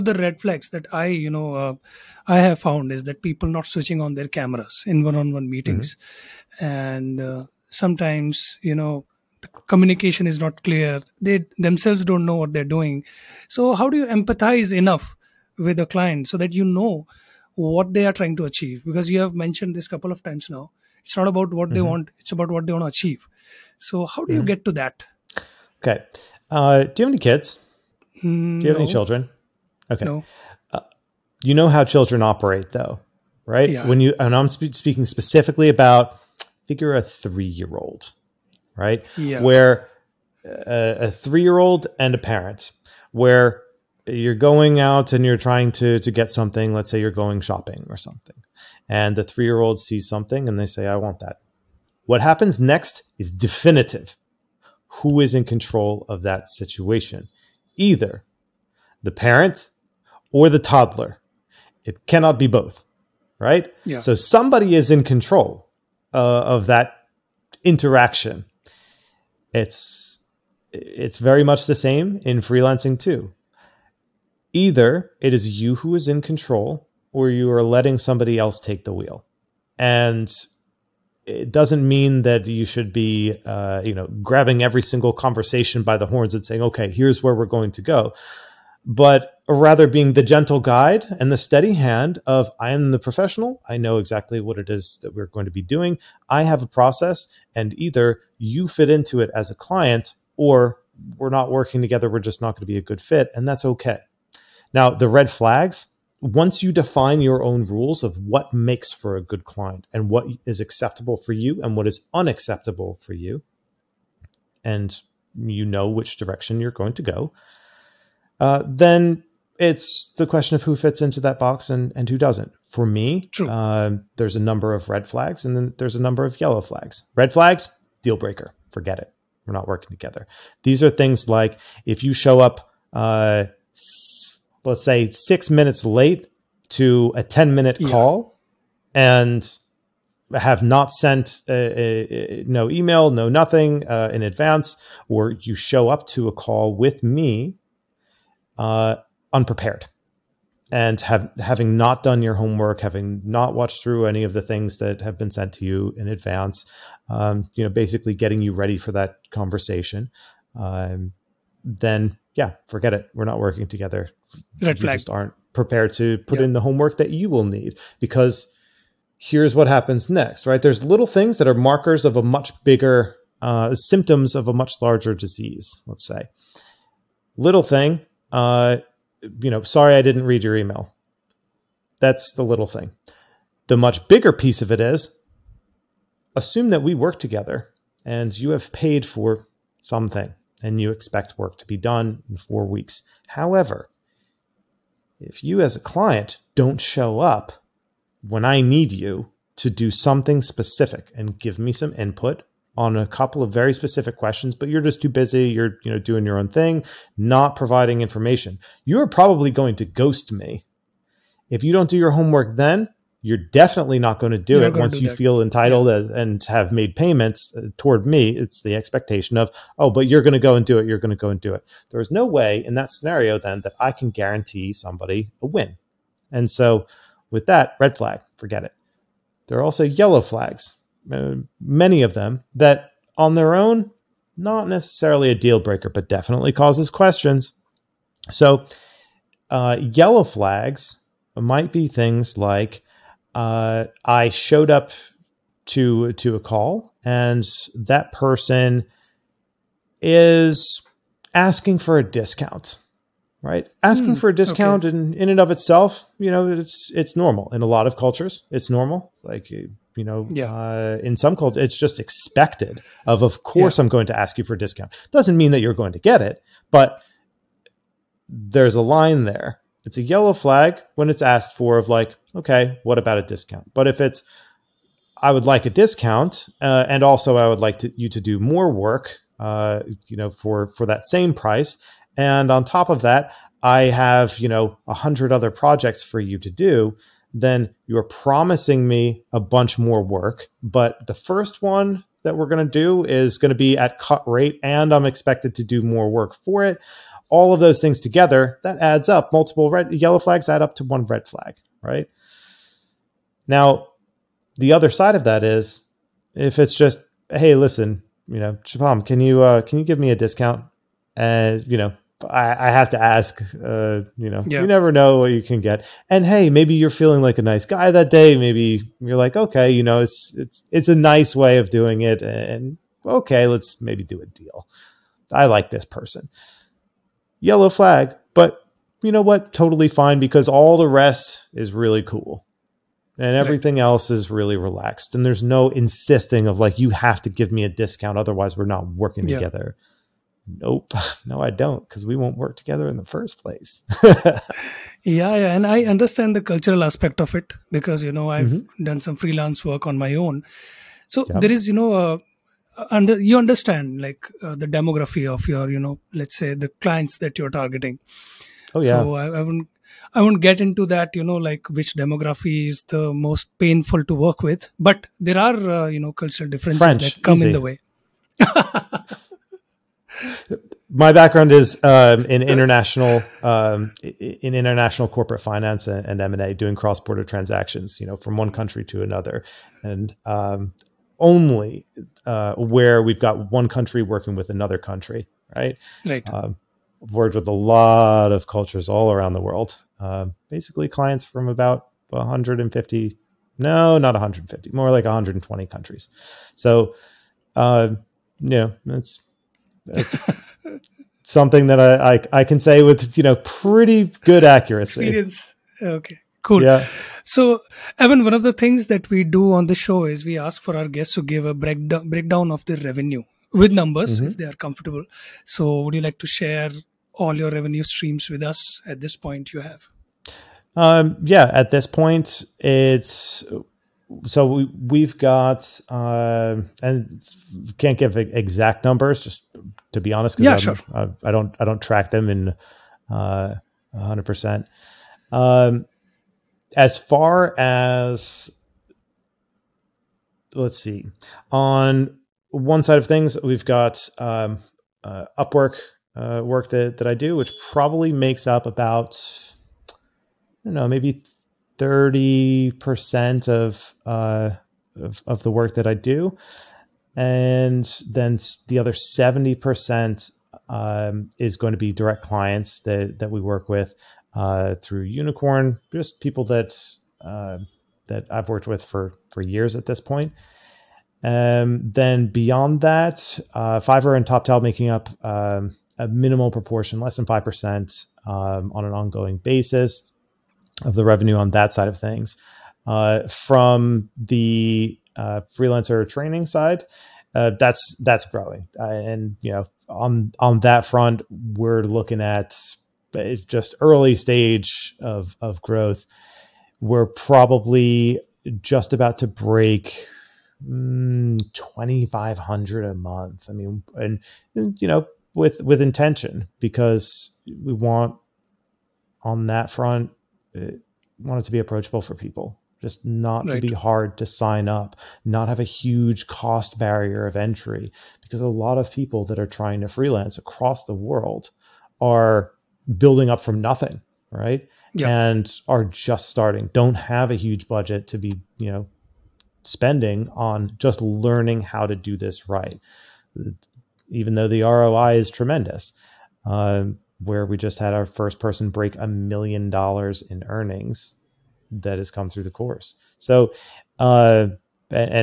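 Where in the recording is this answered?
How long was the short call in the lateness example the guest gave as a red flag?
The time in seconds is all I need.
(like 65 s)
137 s.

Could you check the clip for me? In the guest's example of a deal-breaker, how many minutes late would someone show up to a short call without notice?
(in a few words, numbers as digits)
6.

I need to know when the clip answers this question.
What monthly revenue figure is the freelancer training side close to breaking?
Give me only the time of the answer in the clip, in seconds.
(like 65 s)
501 s.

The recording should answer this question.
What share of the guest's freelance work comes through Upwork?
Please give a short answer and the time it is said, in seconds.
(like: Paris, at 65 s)
30%, at 451 s.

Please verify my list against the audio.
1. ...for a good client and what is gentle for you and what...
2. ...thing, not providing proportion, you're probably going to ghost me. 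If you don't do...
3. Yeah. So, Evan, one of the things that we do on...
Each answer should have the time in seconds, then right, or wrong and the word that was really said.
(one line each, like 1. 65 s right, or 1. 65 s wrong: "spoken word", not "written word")
1. 108 s wrong: "acceptable", not "gentle"
2. 206 s wrong: "information", not "proportion"
3. 406 s right.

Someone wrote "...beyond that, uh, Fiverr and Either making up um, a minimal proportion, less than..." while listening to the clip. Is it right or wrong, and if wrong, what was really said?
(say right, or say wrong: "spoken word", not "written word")
wrong: "Toptal", not "Either".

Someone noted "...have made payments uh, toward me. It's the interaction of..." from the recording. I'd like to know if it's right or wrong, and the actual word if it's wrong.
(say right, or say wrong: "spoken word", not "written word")
wrong: "expectation", not "interaction".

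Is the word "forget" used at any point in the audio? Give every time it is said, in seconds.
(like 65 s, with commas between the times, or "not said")
128 s, 162 s, 228 s.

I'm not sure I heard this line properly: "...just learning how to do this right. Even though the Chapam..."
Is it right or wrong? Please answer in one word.
wrong.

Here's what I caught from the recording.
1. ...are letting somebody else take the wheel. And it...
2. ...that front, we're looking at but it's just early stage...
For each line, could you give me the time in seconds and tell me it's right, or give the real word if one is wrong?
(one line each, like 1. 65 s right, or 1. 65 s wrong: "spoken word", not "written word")
1. 77 s right
2. 490 s right.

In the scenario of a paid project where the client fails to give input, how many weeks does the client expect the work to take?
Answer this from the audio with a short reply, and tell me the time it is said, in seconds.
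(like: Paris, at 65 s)
4 weeks, at 192 s.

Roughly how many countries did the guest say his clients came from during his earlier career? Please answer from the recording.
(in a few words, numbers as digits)
120.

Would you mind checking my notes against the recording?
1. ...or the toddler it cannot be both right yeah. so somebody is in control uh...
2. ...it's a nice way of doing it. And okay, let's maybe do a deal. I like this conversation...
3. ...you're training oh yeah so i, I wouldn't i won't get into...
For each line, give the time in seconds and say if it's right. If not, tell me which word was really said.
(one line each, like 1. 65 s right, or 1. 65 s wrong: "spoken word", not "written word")
1. 60 s right
2. 320 s wrong: "person", not "conversation"
3. 357 s wrong: "targeting", not "training".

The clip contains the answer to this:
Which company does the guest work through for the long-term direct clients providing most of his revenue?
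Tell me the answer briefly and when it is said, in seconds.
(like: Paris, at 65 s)
Unicorn, at 465 s.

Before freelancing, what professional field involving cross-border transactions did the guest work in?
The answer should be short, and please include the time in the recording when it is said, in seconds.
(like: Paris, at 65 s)
International corporate finance, at 374 s.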